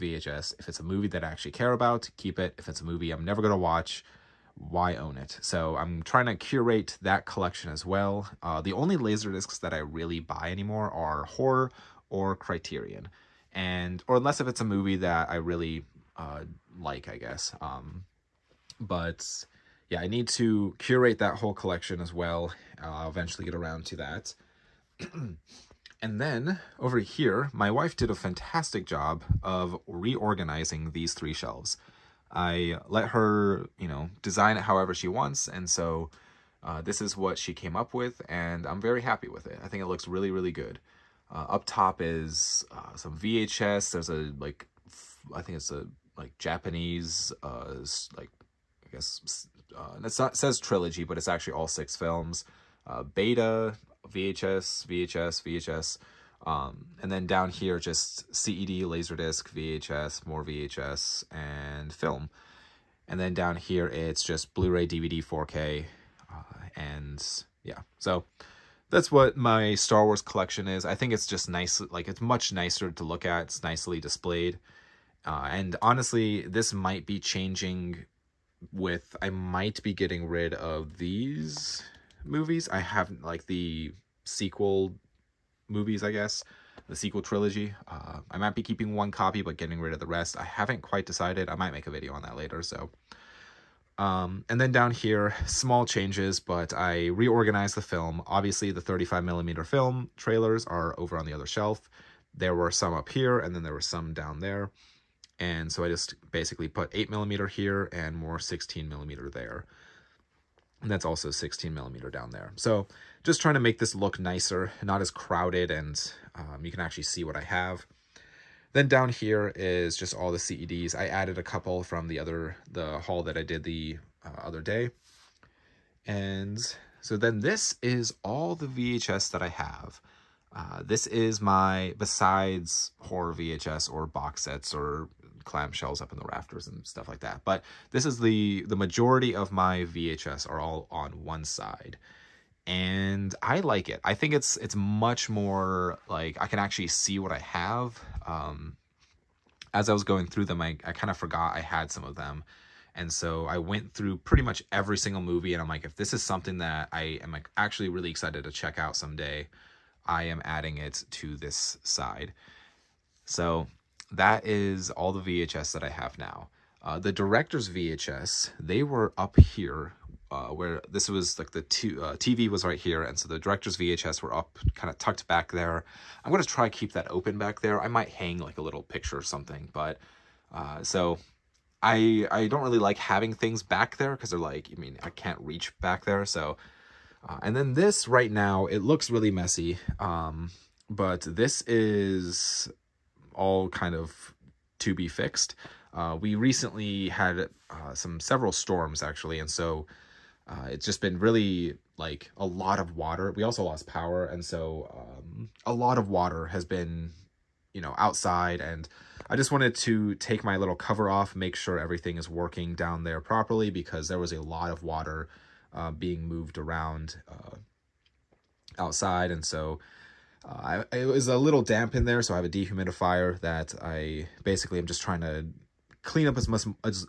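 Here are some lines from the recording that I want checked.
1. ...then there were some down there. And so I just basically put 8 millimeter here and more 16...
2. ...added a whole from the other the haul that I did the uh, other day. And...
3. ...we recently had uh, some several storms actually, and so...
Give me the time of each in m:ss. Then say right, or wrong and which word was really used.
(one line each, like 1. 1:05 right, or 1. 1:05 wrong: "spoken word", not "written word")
1. 1:43 right
2. 2:01 wrong: "couple", not "whole"
3. 3:16 right.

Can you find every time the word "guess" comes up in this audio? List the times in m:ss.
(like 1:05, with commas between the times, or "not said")
0:17, 0:48, 1:26.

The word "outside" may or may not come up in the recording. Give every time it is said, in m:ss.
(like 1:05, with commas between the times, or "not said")
3:27, 3:38.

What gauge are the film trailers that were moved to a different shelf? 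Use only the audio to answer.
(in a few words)
35 millimeter.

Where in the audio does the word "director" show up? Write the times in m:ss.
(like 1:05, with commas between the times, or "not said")
2:47, 2:53.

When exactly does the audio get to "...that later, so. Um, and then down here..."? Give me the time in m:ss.
1:32.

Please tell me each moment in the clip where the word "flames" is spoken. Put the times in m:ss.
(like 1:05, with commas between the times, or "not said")
not said.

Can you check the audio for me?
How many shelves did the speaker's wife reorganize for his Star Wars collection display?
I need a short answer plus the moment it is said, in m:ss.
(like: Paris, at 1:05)
3, at 0:31.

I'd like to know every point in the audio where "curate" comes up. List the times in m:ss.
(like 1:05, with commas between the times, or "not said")
0:06, 0:20.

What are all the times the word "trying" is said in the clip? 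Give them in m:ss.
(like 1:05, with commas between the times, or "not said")
0:06, 1:53, 3:45.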